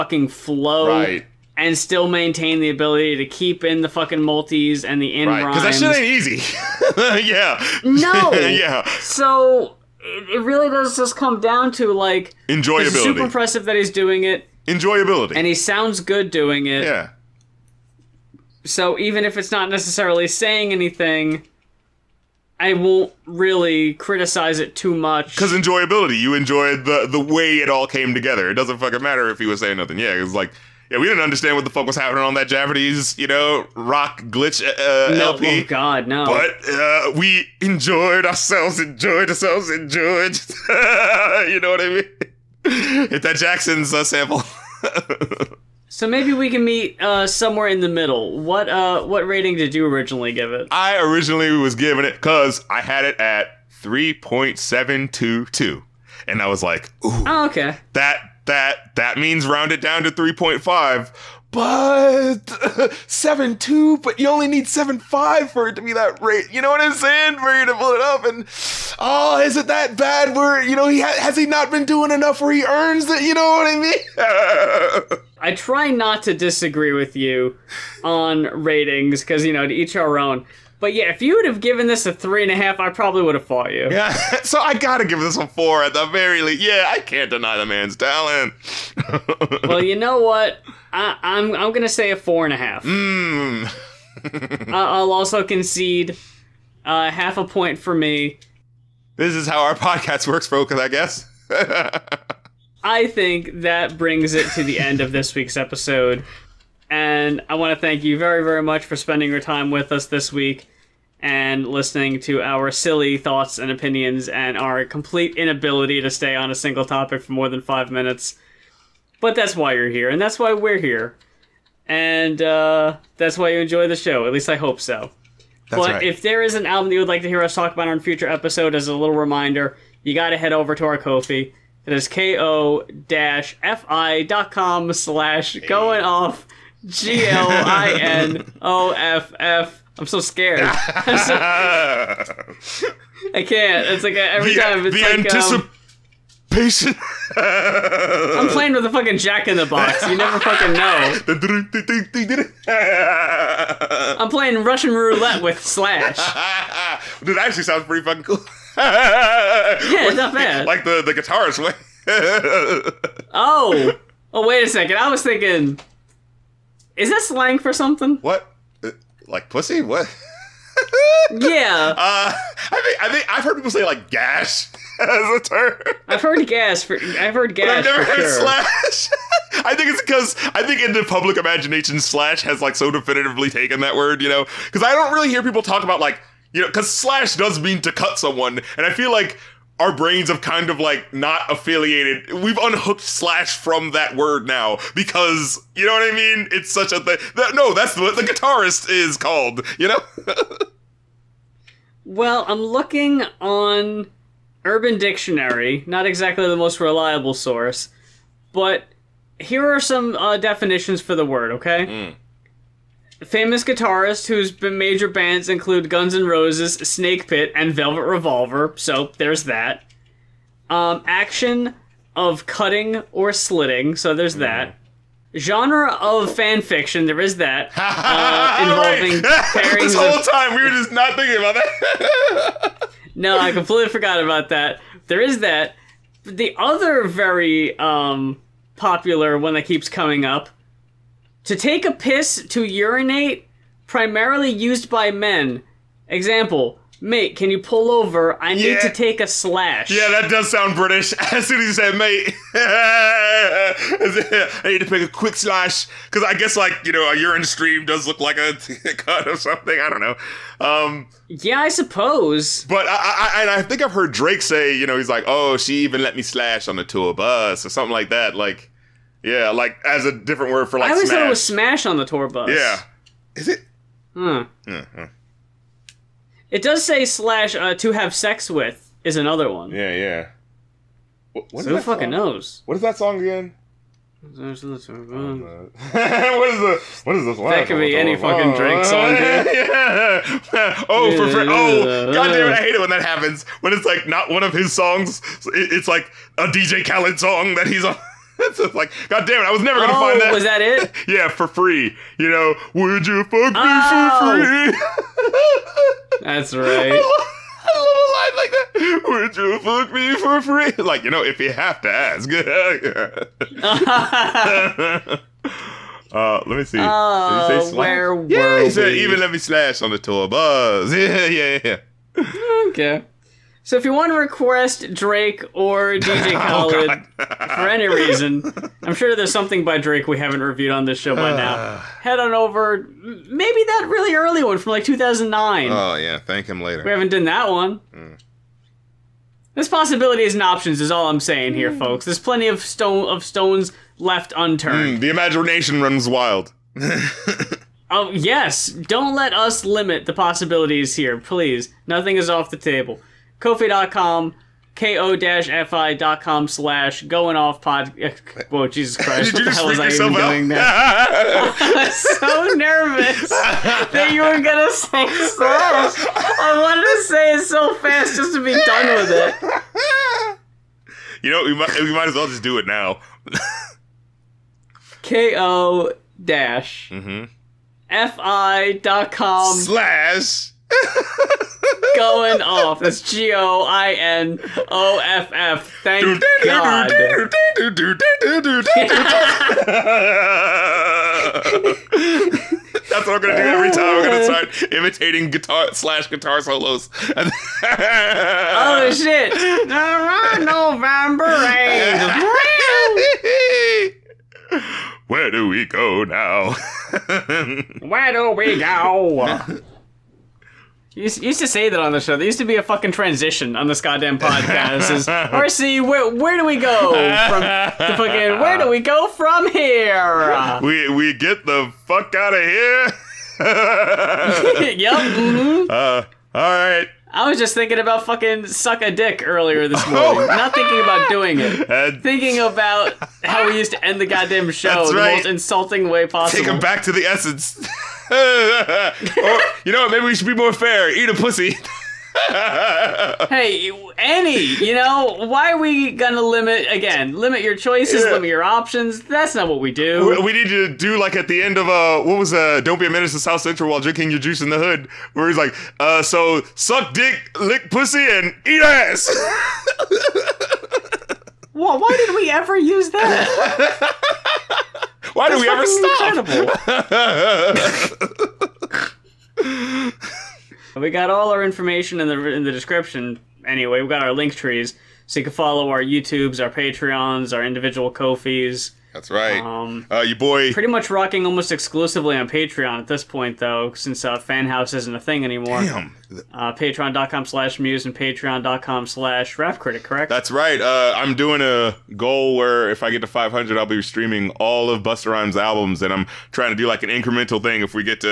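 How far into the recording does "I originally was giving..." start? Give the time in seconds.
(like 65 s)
50 s.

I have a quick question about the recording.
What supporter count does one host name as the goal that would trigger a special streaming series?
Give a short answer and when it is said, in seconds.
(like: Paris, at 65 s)
500, at 493 s.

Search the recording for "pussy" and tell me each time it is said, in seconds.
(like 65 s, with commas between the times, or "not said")
169 s, 441 s, 457 s.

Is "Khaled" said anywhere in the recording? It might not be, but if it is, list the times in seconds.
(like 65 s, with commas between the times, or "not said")
296 s, 326 s.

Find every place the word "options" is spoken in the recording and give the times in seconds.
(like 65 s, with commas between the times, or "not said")
340 s, 448 s.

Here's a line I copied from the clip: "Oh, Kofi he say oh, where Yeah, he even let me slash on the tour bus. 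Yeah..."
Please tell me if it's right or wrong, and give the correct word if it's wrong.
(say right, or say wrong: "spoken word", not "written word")
wrong: "Did", not "Kofi".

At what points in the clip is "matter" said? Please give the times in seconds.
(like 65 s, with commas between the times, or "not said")
29 s.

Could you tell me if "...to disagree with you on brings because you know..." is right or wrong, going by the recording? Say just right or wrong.
wrong.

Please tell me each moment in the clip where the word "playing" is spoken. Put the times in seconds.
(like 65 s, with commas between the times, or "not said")
148 s, 154 s.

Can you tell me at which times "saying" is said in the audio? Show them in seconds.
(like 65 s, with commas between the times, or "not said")
20 s, 29 s, 66 s, 341 s.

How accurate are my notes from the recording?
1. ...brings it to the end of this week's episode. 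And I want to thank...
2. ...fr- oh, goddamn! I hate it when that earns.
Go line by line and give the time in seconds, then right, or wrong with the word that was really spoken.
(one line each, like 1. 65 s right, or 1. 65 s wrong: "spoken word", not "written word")
1. 103 s right
2. 291 s wrong: "happens", not "earns".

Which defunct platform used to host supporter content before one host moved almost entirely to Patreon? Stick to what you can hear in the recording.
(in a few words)
Fanhouse.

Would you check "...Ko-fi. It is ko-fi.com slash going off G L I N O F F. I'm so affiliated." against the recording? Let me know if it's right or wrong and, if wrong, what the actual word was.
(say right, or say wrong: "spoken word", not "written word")
wrong: "scared", not "affiliated".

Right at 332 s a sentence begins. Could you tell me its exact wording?
Head on over, maybe that really early one from like 2009.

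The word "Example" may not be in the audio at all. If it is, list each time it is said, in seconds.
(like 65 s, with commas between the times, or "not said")
246 s.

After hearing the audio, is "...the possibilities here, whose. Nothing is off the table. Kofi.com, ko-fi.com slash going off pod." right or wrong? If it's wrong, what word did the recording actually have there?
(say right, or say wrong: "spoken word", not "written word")
wrong: "please", not "whose".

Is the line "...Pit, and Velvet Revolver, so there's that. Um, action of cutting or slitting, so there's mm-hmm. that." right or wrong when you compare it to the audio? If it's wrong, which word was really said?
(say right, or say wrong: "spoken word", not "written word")
right.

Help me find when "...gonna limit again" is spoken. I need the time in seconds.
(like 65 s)
445 s.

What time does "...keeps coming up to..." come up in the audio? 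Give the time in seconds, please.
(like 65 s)
239 s.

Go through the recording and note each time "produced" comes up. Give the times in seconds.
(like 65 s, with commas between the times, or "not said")
not said.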